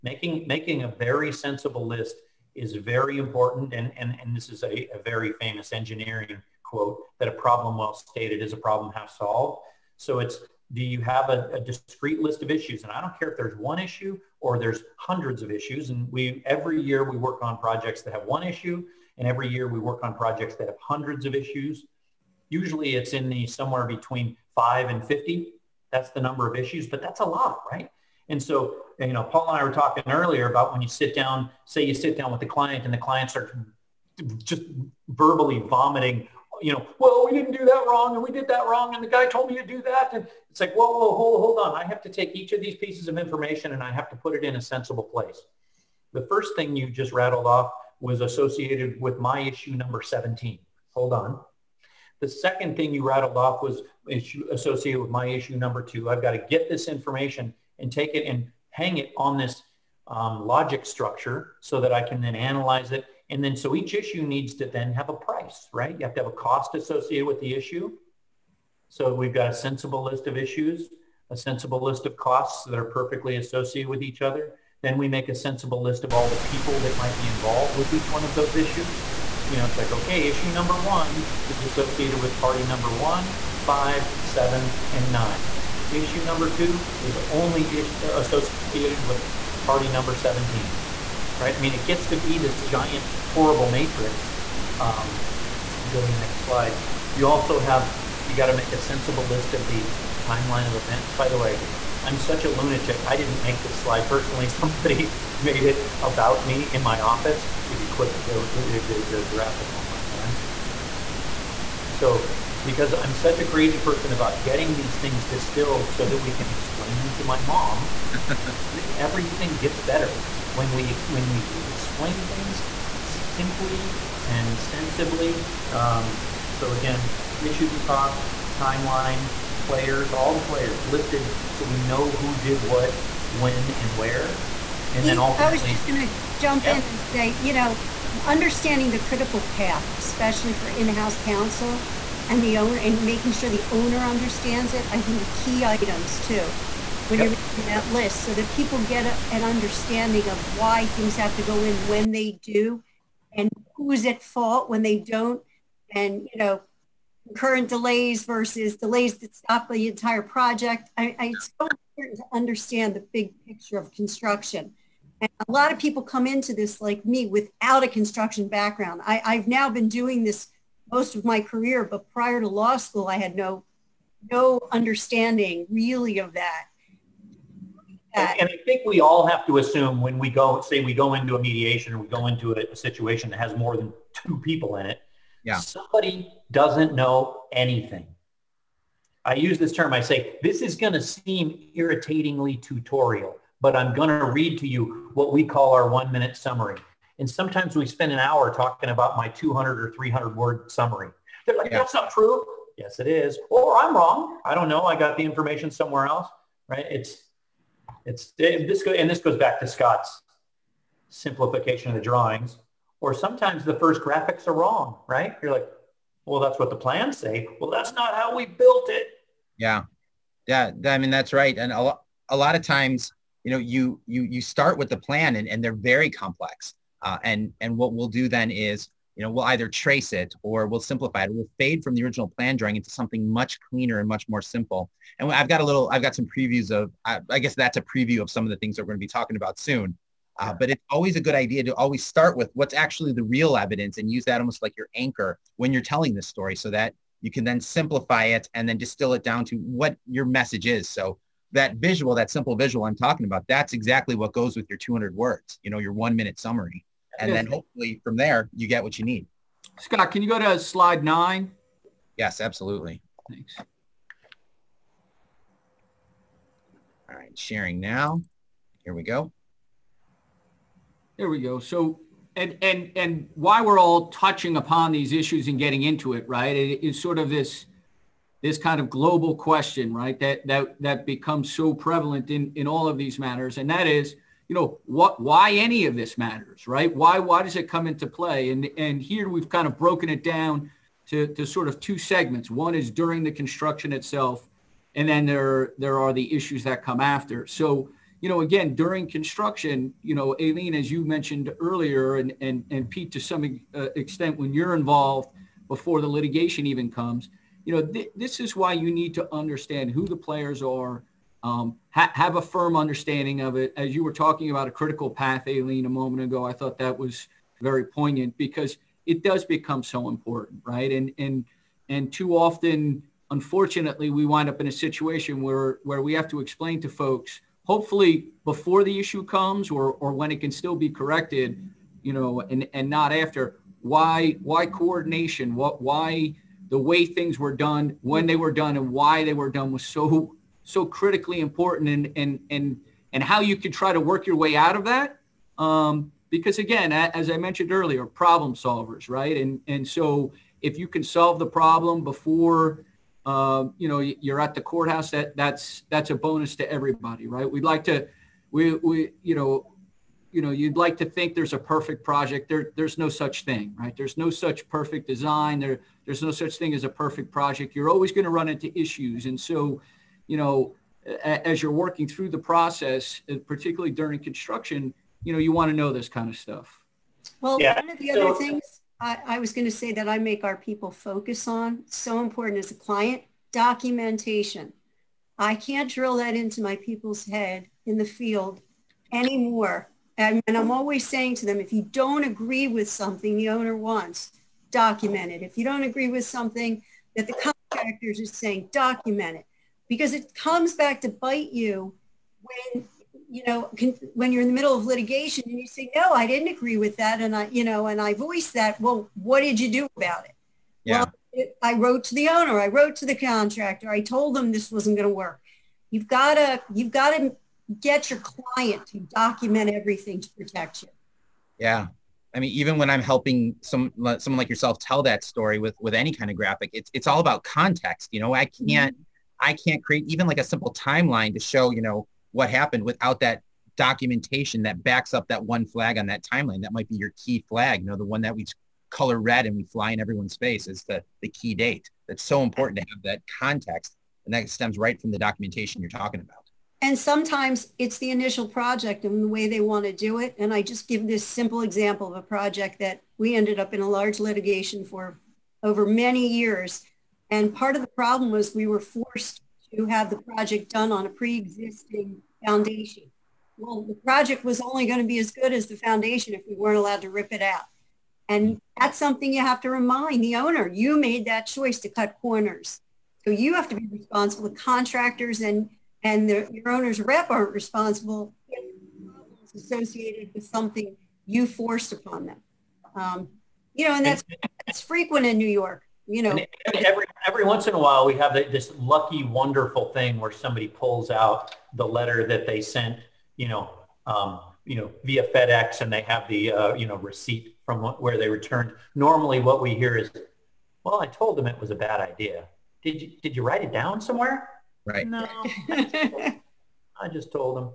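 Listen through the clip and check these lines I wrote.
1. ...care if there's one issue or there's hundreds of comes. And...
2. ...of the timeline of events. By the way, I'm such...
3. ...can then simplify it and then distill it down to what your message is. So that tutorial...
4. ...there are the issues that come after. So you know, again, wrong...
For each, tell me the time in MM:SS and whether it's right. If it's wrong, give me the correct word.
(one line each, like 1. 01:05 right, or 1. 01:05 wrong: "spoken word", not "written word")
1. 00:13 wrong: "issues", not "comes"
2. 01:39 right
3. 04:07 wrong: "visual", not "tutorial"
4. 04:55 wrong: "during", not "wrong".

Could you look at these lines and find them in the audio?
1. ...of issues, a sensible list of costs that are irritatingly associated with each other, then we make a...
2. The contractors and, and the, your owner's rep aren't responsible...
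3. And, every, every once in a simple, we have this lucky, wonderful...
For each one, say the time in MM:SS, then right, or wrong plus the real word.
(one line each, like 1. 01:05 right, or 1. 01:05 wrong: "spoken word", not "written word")
1. 01:10 wrong: "perfectly", not "irritatingly"
2. 07:54 right
3. 08:06 wrong: "while", not "simple".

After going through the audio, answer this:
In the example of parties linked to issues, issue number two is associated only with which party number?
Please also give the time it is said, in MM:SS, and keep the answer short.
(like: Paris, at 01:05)
17, at 01:29.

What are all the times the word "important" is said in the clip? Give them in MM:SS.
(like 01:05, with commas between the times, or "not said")
00:03, 02:41, 05:20, 05:41, 06:22, 07:22.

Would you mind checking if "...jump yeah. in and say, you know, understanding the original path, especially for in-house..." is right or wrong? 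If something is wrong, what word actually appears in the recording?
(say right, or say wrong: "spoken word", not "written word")
wrong: "critical", not "original".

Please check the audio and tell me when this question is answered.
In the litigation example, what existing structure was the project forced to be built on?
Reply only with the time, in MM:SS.
07:41.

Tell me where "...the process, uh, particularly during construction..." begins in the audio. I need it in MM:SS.
06:12.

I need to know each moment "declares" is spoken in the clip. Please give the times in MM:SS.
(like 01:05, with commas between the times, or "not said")
not said.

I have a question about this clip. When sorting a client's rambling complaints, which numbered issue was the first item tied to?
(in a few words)
17.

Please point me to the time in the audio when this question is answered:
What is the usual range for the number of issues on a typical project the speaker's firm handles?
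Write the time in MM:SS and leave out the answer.
00:23.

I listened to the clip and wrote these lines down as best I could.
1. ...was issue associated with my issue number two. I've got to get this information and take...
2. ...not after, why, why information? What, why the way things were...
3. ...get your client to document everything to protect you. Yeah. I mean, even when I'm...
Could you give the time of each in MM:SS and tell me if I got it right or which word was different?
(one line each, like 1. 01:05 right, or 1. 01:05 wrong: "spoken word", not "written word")
1. 00:53 right
2. 05:32 wrong: "coordination", not "information"
3. 06:57 right.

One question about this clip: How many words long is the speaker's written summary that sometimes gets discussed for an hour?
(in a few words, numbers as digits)
200 or 300.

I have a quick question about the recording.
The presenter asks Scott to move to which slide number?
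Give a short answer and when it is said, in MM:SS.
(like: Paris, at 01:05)
9, at 04:20.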